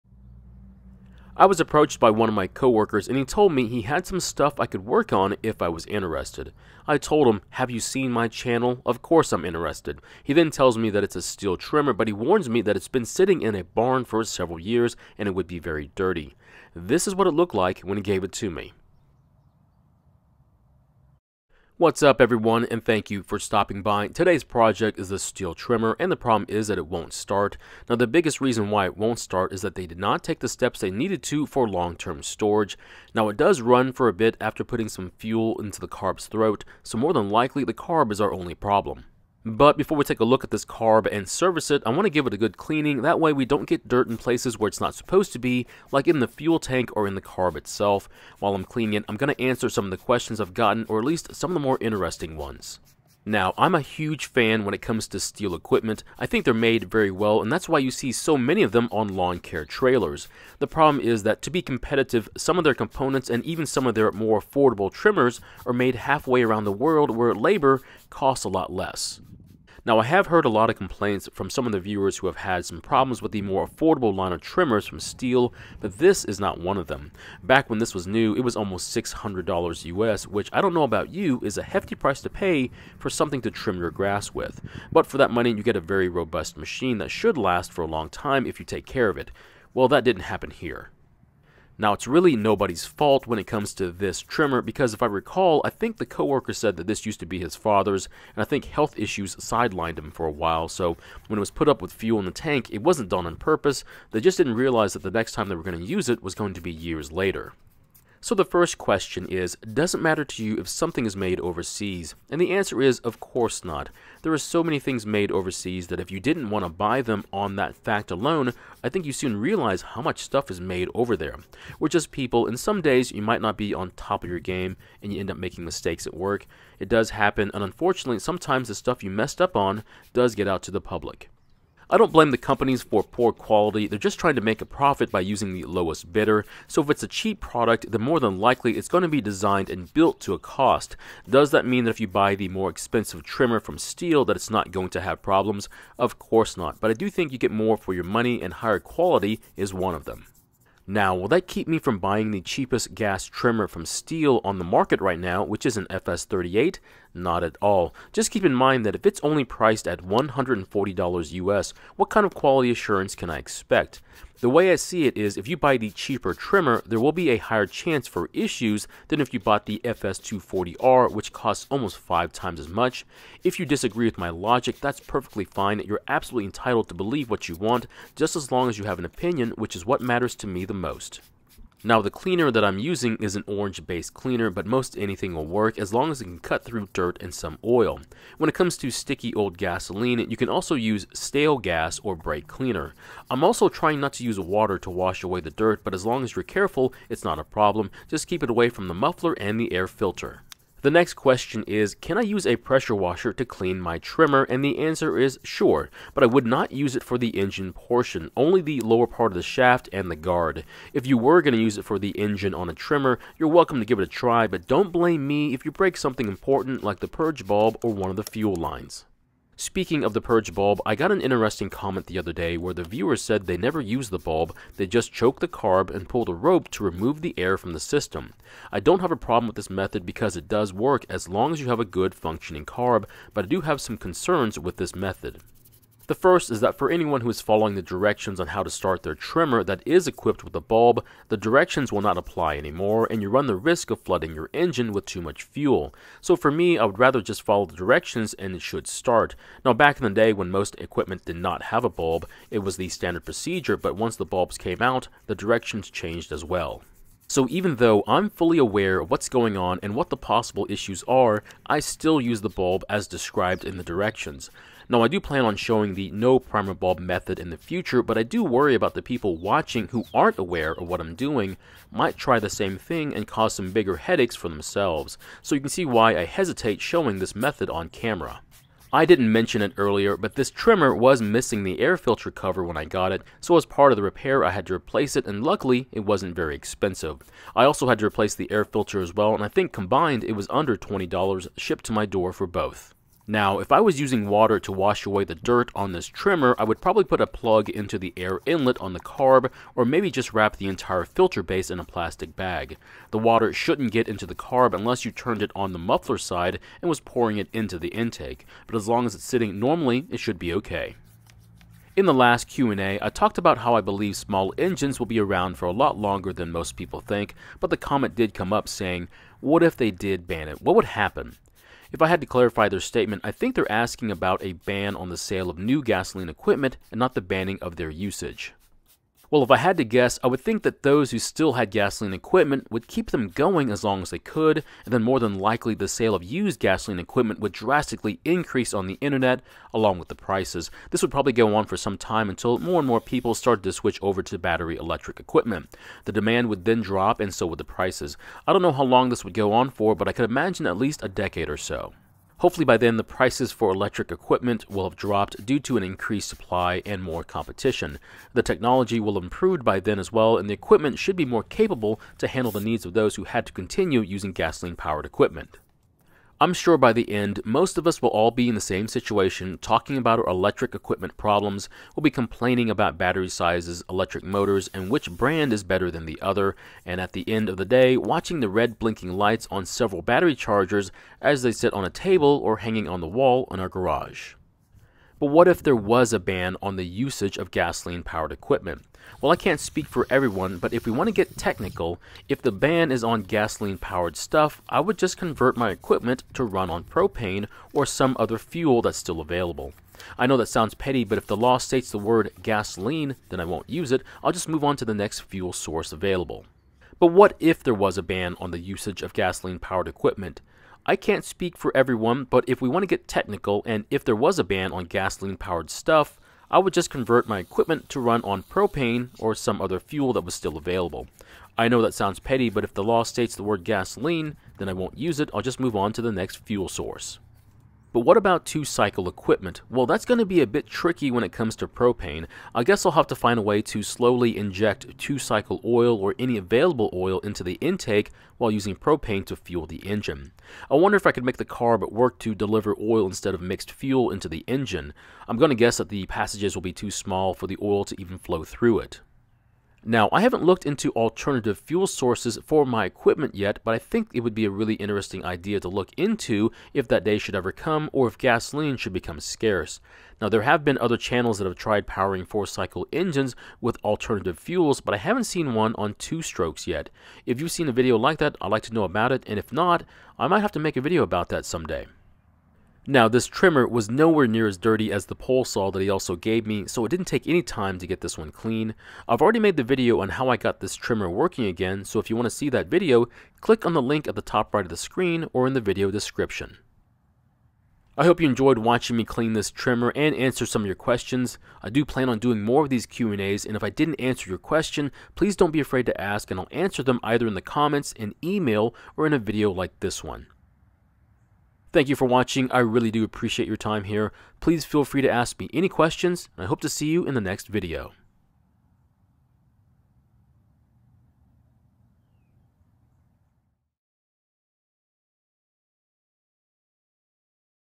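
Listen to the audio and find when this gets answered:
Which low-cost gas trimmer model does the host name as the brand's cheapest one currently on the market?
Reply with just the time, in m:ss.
2:35.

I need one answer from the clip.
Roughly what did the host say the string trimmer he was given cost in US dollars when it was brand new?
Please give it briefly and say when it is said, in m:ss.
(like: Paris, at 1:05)
$600, at 1:18.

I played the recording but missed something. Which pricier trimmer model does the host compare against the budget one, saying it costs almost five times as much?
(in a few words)
FS240R.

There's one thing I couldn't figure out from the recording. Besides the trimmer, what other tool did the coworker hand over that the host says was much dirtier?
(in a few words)
pole saw.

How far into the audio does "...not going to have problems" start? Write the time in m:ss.
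2:24.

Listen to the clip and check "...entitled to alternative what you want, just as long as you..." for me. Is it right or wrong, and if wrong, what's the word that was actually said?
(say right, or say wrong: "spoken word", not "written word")
wrong: "believe", not "alternative".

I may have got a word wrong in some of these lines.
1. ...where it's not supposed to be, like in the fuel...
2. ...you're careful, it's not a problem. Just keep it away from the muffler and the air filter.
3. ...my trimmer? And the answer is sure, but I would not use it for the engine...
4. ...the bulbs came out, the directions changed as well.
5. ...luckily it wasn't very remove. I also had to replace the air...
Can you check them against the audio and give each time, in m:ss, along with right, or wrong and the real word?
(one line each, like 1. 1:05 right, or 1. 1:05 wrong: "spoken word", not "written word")
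1. 0:44 right
2. 3:16 right
3. 3:23 right
4. 4:14 right
5. 4:45 wrong: "expensive", not "remove".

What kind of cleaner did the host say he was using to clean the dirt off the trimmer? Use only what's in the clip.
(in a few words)
orange based cleaner.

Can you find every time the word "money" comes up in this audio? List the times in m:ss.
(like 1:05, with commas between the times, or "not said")
1:25, 2:28.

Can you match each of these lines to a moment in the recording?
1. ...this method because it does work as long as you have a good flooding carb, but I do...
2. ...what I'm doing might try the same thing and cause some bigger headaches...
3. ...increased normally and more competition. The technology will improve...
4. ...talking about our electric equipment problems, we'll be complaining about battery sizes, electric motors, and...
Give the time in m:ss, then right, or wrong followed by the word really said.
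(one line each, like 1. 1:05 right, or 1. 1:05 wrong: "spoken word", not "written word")
1. 3:49 wrong: "functioning", not "flooding"
2. 4:30 right
3. 5:55 wrong: "supply", not "normally"
4. 6:09 right.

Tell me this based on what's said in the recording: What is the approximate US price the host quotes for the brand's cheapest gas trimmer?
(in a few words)
$140.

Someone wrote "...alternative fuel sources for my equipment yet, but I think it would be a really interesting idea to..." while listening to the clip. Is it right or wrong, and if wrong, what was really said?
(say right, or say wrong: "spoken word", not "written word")
right.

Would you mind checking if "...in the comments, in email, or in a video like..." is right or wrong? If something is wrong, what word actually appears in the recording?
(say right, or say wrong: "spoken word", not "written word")
right.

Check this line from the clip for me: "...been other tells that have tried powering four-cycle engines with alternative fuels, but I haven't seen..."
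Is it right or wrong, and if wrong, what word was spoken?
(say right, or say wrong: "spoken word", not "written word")
wrong: "channels", not "tells".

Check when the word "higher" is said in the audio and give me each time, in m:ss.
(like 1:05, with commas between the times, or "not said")
2:28, 2:47.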